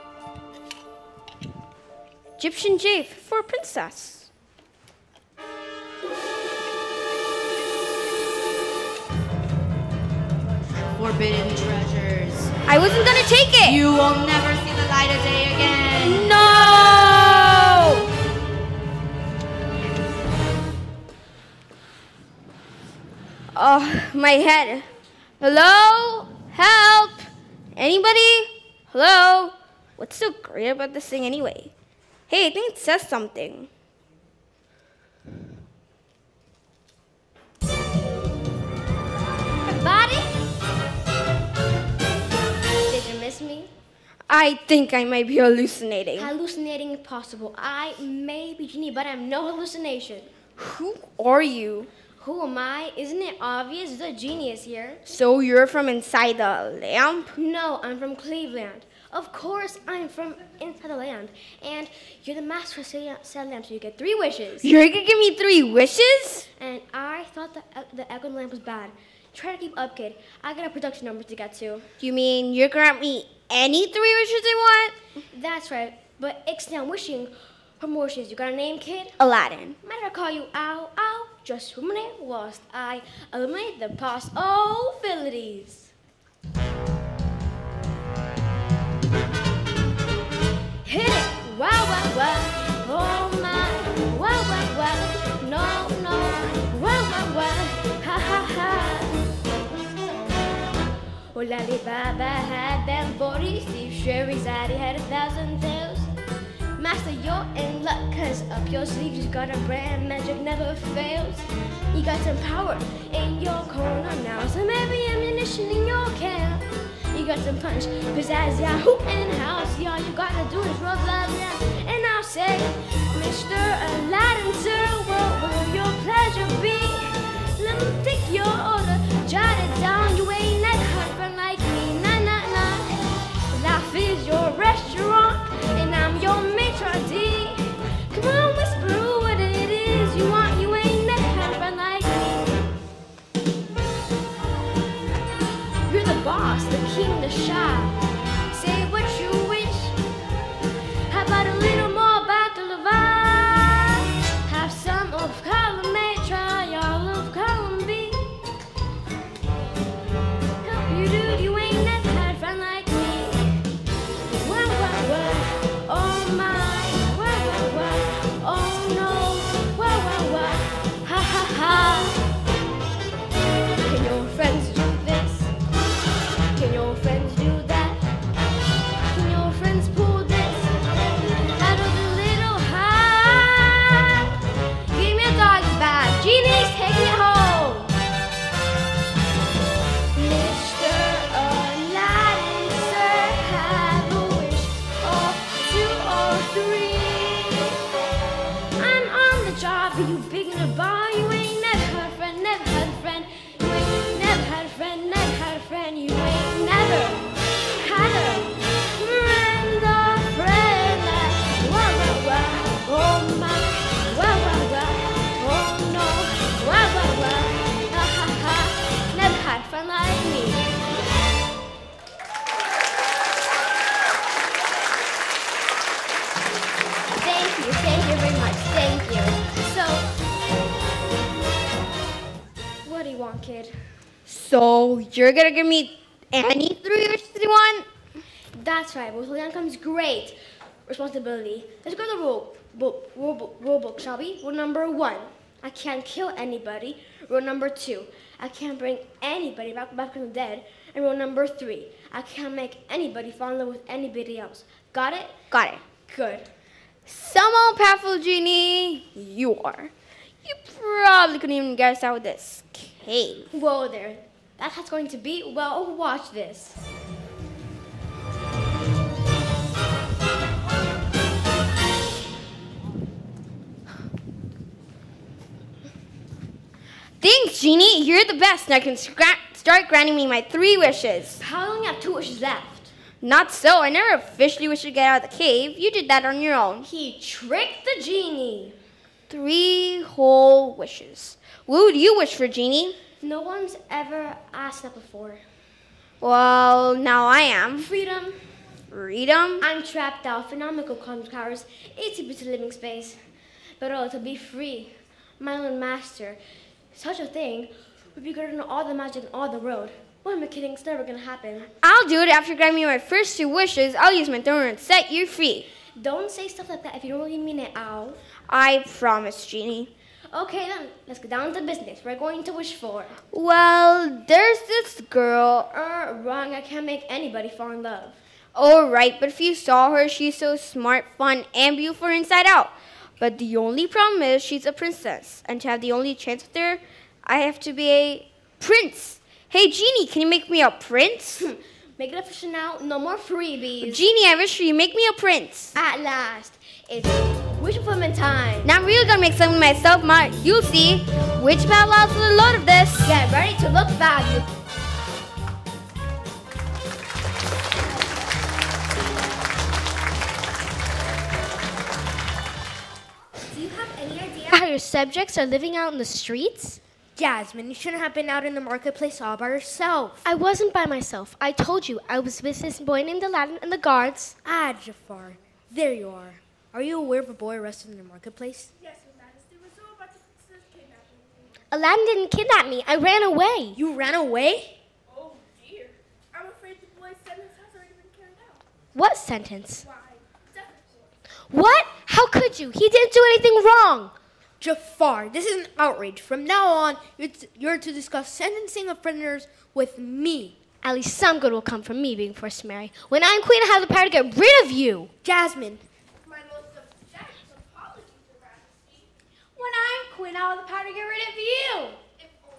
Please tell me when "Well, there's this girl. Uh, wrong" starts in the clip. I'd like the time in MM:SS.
05:23.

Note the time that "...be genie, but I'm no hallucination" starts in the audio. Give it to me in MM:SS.
00:48.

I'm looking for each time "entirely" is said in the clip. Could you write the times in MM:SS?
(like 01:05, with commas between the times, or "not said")
not said.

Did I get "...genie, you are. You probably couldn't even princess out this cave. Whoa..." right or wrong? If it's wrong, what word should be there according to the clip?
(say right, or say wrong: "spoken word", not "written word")
wrong: "guess", not "princess".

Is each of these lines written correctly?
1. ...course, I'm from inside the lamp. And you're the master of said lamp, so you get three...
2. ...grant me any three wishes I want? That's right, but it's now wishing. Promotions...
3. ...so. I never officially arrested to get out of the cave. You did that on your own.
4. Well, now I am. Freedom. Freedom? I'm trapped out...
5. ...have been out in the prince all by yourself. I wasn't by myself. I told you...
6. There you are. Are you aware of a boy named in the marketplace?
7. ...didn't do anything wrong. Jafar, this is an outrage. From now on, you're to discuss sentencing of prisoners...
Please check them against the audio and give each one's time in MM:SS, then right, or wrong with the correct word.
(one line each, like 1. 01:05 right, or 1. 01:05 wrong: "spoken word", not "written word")
1. 00:59 right
2. 01:12 right
3. 04:43 wrong: "wished", not "arrested"
4. 04:56 right
5. 06:08 wrong: "marketplace", not "prince"
6. 06:15 wrong: "arrested", not "named"
7. 06:32 right.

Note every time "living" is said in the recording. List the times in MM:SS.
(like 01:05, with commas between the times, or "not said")
05:02, 06:05.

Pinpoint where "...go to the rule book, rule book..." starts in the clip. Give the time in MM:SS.
04:01.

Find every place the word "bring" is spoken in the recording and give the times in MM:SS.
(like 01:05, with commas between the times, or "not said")
04:08.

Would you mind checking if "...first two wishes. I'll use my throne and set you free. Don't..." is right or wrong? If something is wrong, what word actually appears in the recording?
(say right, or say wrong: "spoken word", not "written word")
right.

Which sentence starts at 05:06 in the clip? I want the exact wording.
Such a thing would be greater than all the magic in all the world.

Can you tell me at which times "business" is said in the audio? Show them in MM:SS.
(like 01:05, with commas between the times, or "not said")
05:21.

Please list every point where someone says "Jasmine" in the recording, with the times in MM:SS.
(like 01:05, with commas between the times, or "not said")
06:07, 06:45.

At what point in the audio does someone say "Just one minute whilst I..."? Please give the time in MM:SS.
01:21.